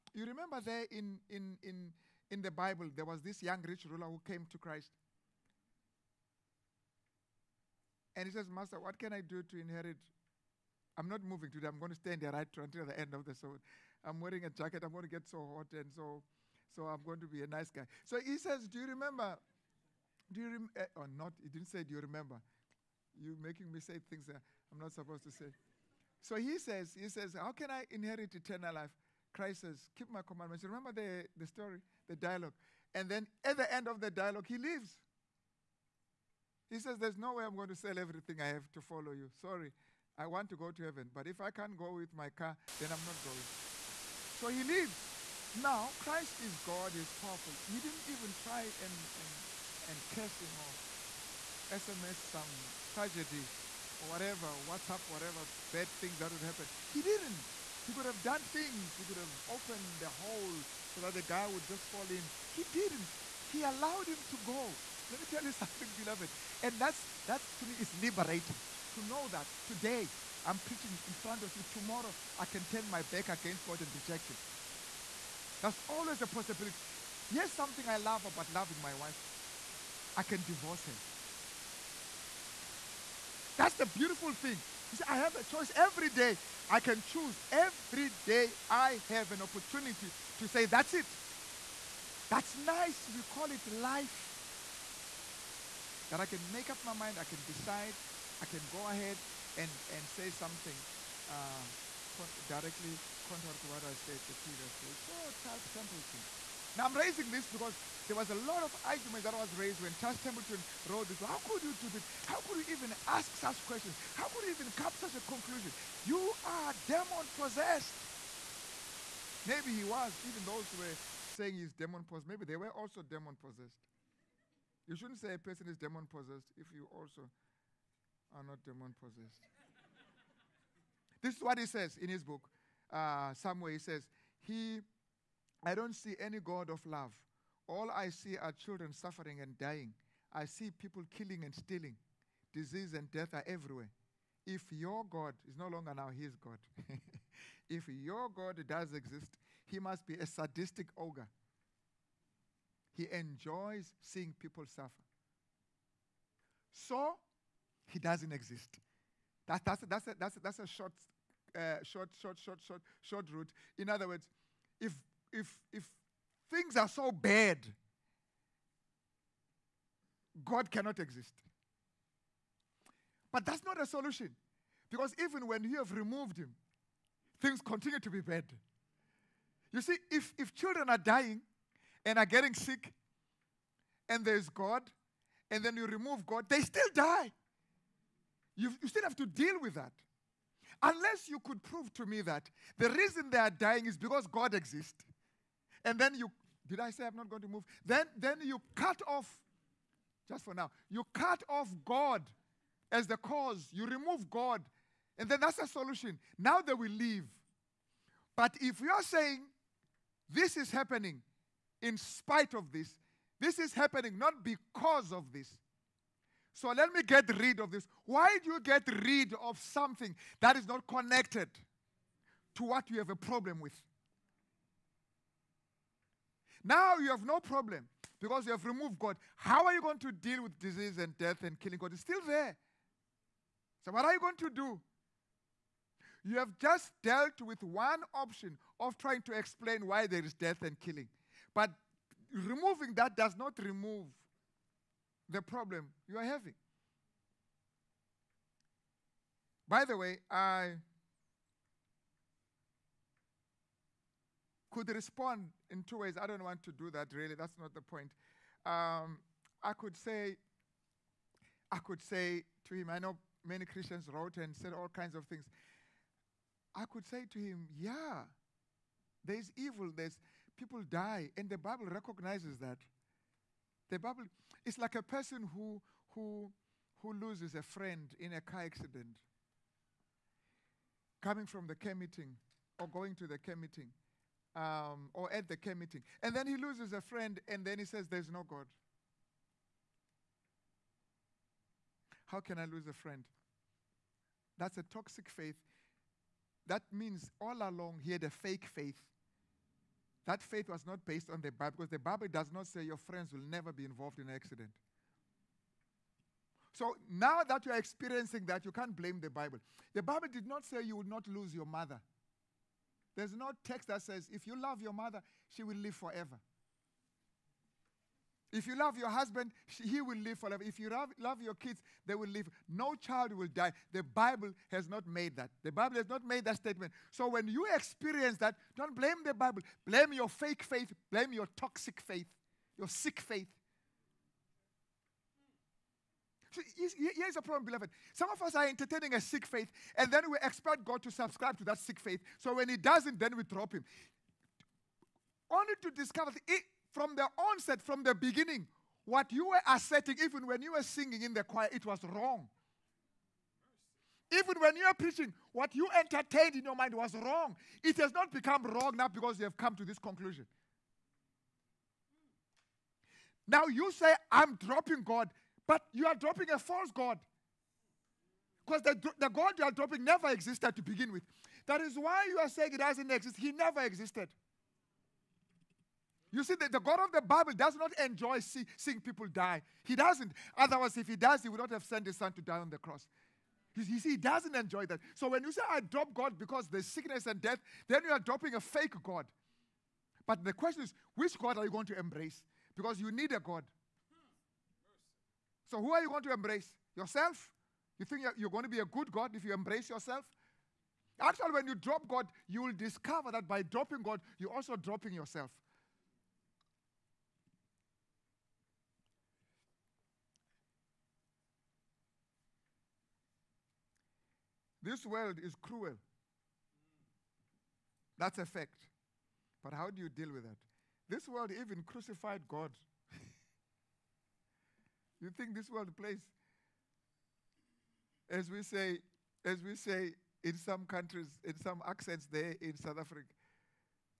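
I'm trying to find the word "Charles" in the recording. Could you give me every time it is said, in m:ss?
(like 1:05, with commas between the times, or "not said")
1:45, 1:49.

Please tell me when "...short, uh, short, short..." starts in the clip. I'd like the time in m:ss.
2:40.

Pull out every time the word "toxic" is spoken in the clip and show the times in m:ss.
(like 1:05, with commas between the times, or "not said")
4:54, 5:31.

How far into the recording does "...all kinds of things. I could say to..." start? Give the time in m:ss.
4:24.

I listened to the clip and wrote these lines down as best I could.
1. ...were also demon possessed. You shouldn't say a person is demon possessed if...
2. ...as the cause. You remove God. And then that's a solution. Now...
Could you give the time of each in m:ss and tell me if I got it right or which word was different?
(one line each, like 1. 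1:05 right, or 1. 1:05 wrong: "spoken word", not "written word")
1. 2:02 right
2. 3:22 right.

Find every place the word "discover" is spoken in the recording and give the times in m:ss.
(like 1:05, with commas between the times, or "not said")
5:45, 6:42.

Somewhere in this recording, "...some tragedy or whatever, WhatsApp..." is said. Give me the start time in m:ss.
0:52.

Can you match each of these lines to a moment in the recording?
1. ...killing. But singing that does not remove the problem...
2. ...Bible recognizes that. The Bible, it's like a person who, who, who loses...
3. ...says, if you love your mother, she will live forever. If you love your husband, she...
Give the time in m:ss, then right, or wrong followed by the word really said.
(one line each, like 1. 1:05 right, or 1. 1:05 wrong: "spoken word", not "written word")
1. 4:00 wrong: "removing", not "singing"
2. 4:31 right
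3. 5:14 right.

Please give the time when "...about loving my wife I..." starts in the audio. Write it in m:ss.
1:18.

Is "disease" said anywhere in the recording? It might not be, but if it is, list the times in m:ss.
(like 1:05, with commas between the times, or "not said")
2:22, 3:50.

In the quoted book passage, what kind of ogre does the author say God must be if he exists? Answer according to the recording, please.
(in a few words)
sadistic.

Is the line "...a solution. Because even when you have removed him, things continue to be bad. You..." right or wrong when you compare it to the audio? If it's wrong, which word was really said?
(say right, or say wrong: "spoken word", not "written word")
right.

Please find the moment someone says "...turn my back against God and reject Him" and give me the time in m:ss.
1:12.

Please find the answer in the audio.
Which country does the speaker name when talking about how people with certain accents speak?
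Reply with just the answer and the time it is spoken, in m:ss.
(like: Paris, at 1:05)
South Africa, at 7:12.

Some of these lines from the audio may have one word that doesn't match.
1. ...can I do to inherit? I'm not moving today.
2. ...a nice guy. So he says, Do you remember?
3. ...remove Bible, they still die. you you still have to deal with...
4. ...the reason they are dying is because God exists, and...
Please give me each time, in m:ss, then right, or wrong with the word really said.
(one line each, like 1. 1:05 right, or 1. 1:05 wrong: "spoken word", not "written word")
1. 0:08 right
2. 0:17 right
3. 3:05 wrong: "God", not "Bible"
4. 3:12 right.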